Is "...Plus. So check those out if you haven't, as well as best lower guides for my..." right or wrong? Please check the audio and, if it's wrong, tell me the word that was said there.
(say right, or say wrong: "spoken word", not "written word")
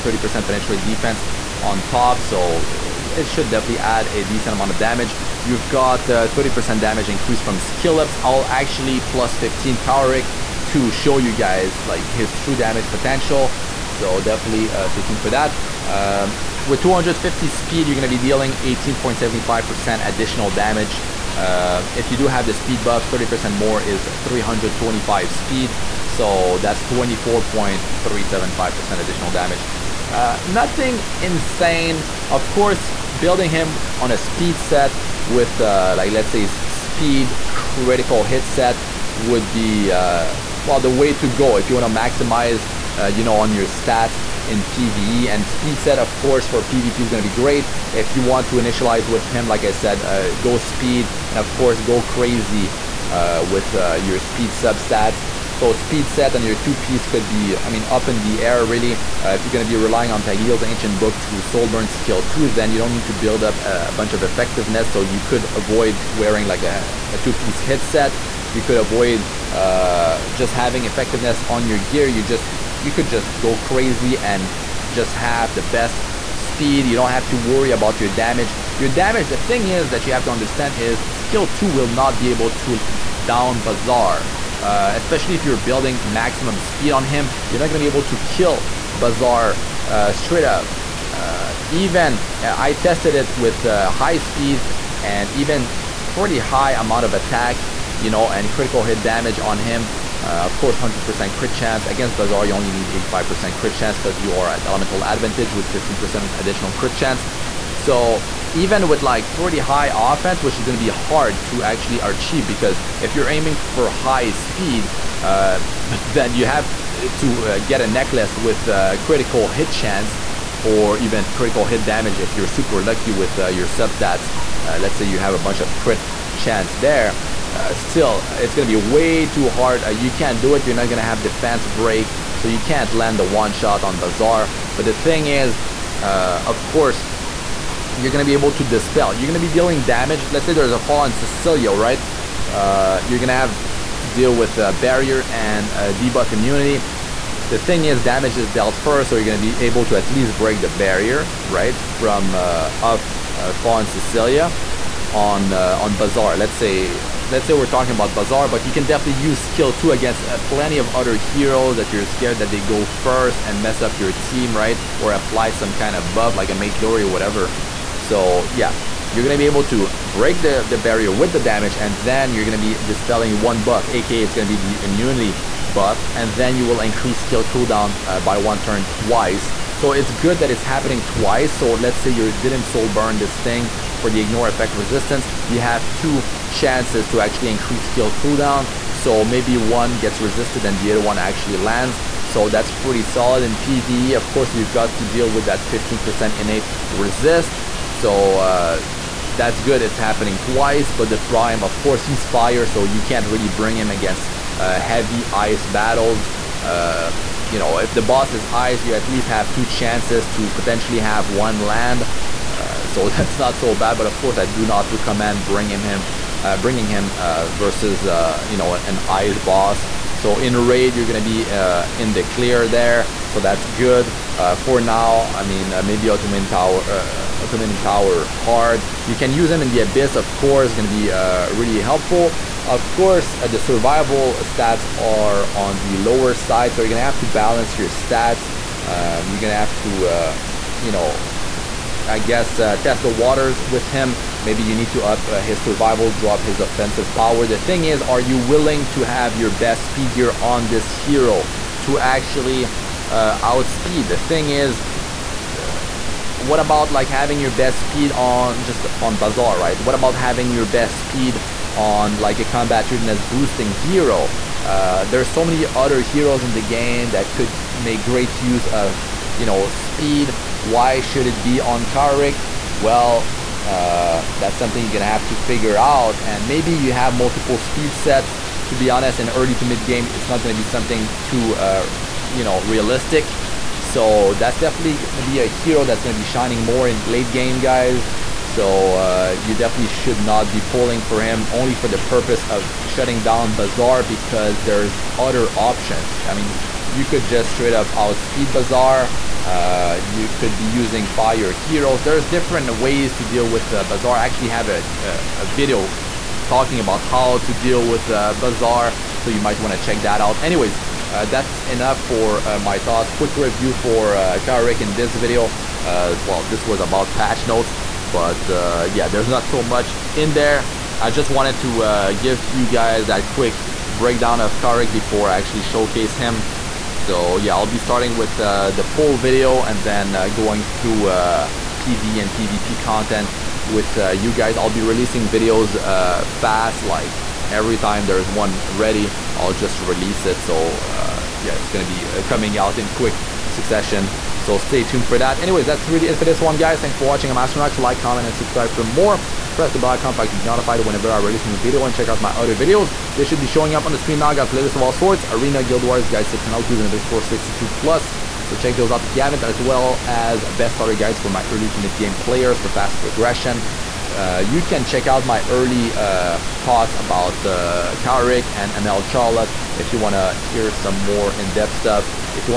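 wrong: "starter", not "lower".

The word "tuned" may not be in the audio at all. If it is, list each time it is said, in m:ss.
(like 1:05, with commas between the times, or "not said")
0:15, 5:44.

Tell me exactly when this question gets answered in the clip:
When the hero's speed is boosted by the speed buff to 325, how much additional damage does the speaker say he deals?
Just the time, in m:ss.
0:26.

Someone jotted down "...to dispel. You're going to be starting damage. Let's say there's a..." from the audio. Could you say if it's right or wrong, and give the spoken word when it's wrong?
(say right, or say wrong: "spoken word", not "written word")
wrong: "dealing", not "starting".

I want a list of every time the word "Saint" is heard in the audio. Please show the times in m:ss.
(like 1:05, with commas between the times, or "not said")
not said.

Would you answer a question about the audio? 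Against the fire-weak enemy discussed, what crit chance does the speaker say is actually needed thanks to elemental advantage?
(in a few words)
85%.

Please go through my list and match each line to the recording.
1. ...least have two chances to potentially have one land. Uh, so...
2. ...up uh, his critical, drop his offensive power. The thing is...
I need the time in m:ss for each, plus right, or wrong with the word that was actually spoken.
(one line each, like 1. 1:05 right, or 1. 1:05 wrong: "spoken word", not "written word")
1. 3:29 right
2. 4:05 wrong: "survival", not "critical".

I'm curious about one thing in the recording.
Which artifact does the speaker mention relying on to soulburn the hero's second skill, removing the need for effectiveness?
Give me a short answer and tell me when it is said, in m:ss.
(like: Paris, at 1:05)
Tagehel's Ancient Book, at 1:00.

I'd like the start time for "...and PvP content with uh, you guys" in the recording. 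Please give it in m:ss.
5:32.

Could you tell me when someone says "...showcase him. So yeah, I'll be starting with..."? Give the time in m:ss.
5:25.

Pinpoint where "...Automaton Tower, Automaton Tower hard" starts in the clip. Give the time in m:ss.
3:46.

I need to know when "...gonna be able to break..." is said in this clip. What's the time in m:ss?
2:49.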